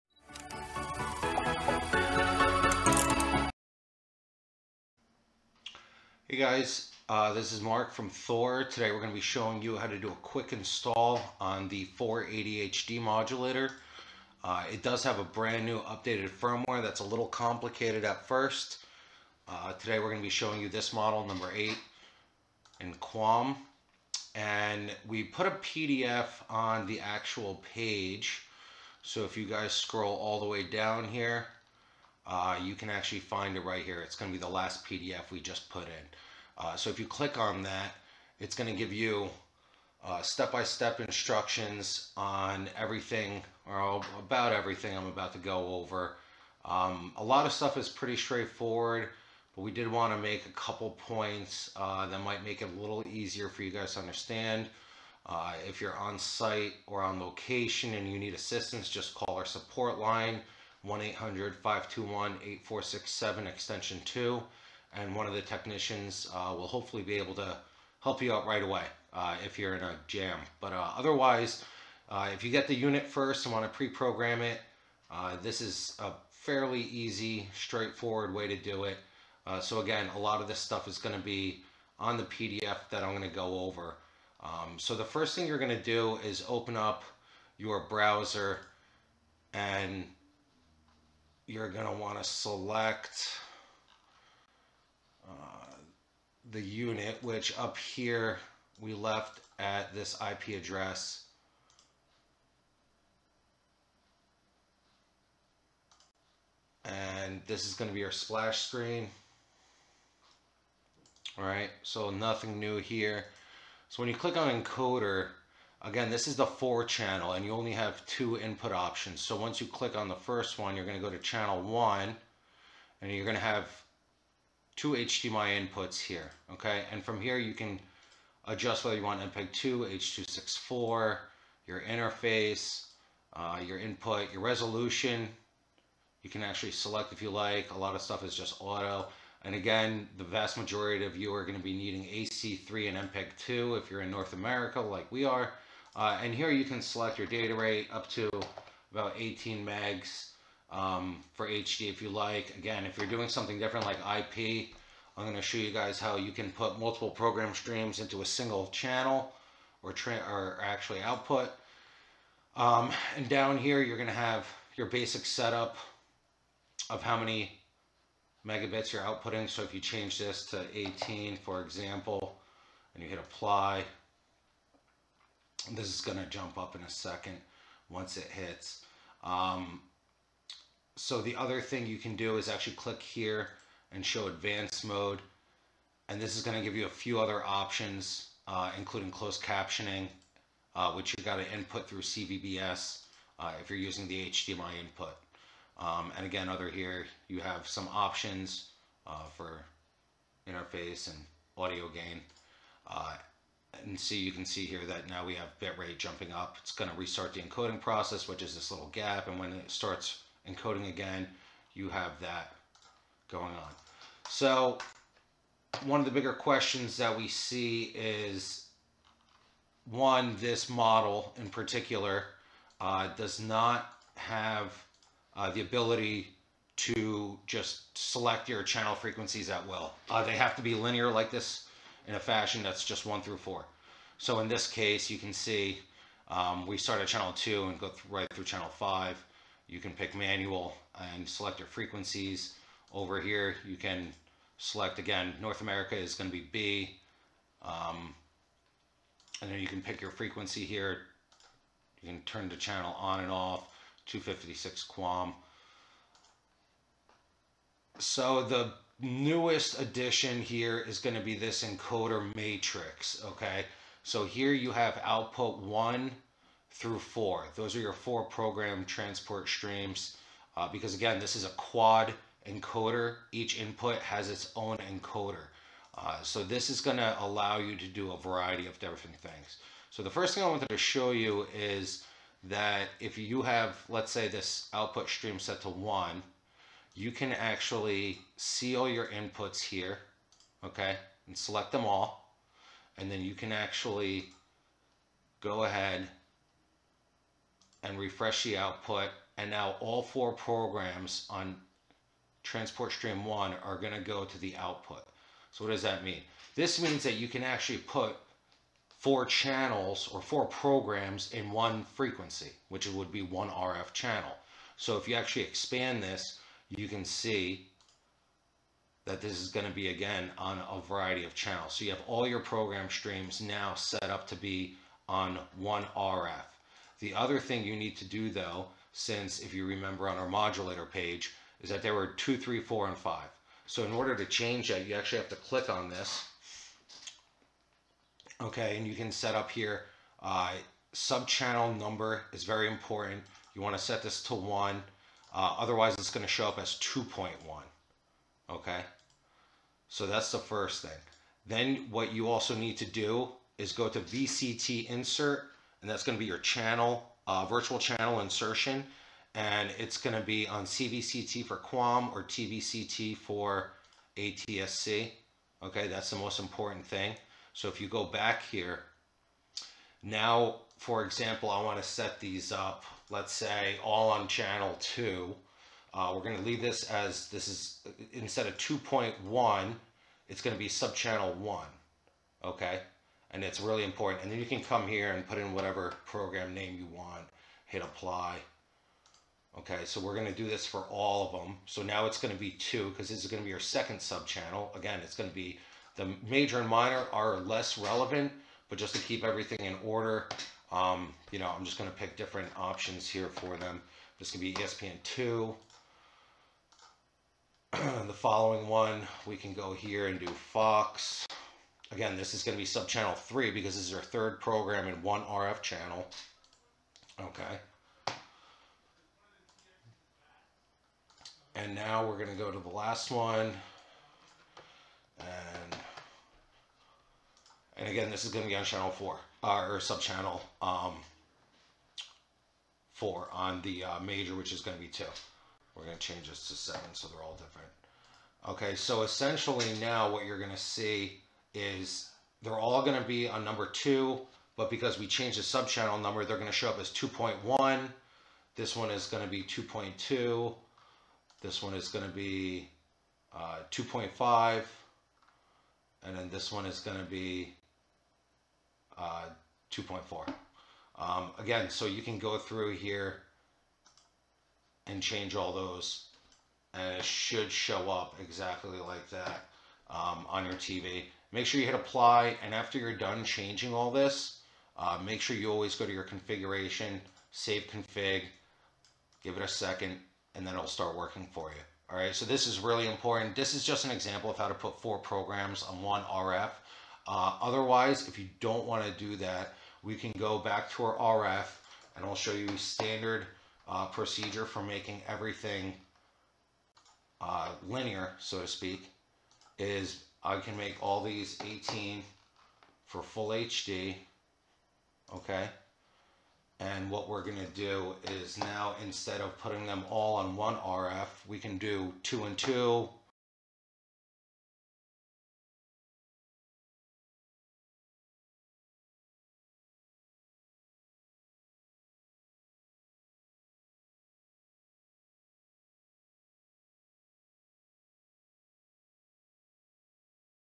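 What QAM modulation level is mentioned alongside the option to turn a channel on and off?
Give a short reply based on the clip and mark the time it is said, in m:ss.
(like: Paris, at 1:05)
256 QAM, at 4:14.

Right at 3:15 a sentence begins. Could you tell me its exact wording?
Um, and again, other here, you have some options uh, for interface and audio gain.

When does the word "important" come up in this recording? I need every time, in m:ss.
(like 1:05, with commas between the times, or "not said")
5:42, 6:06, 6:23, 8:02.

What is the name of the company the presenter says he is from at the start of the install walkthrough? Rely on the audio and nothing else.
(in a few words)
Thor.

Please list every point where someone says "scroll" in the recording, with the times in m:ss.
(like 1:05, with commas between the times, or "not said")
0:29.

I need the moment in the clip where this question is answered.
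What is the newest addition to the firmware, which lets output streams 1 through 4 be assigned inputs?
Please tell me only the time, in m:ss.
4:21.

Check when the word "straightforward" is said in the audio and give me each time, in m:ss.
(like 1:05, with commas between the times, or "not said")
0:48, 1:17.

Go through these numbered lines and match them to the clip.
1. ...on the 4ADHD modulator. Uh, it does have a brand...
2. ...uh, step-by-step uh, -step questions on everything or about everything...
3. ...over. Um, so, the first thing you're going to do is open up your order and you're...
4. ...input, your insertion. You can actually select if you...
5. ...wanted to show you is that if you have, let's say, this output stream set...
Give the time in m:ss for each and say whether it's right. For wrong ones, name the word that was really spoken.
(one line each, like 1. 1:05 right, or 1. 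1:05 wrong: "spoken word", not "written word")
1. 0:11 right
2. 0:40 wrong: "instructions", not "questions"
3. 1:23 wrong: "browser", not "order"
4. 2:13 wrong: "resolution", not "insertion"
5. 4:40 right.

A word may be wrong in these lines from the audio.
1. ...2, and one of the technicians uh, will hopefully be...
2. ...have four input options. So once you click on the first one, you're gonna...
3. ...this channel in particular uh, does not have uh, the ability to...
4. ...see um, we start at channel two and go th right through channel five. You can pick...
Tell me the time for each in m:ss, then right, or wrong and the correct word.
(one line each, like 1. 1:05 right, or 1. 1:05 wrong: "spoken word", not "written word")
1. 1:04 right
2. 1:57 wrong: "two", not "four"
3. 3:40 wrong: "model", not "channel"
4. 3:55 right.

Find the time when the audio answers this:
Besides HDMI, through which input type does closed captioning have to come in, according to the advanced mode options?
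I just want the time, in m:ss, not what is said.
3:12.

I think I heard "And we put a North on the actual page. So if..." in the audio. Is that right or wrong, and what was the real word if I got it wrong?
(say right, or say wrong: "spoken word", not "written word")
wrong: "PDF", not "North".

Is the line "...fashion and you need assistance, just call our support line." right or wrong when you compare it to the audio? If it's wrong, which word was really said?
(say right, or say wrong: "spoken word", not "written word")
wrong: "location", not "fashion".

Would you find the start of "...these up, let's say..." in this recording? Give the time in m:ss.
6:12.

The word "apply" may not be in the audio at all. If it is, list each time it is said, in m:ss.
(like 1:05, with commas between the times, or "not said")
2:53, 6:27, 7:51.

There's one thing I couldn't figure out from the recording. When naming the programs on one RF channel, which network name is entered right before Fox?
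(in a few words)
ESPN2.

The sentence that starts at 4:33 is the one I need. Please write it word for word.
Each input has its own encoder.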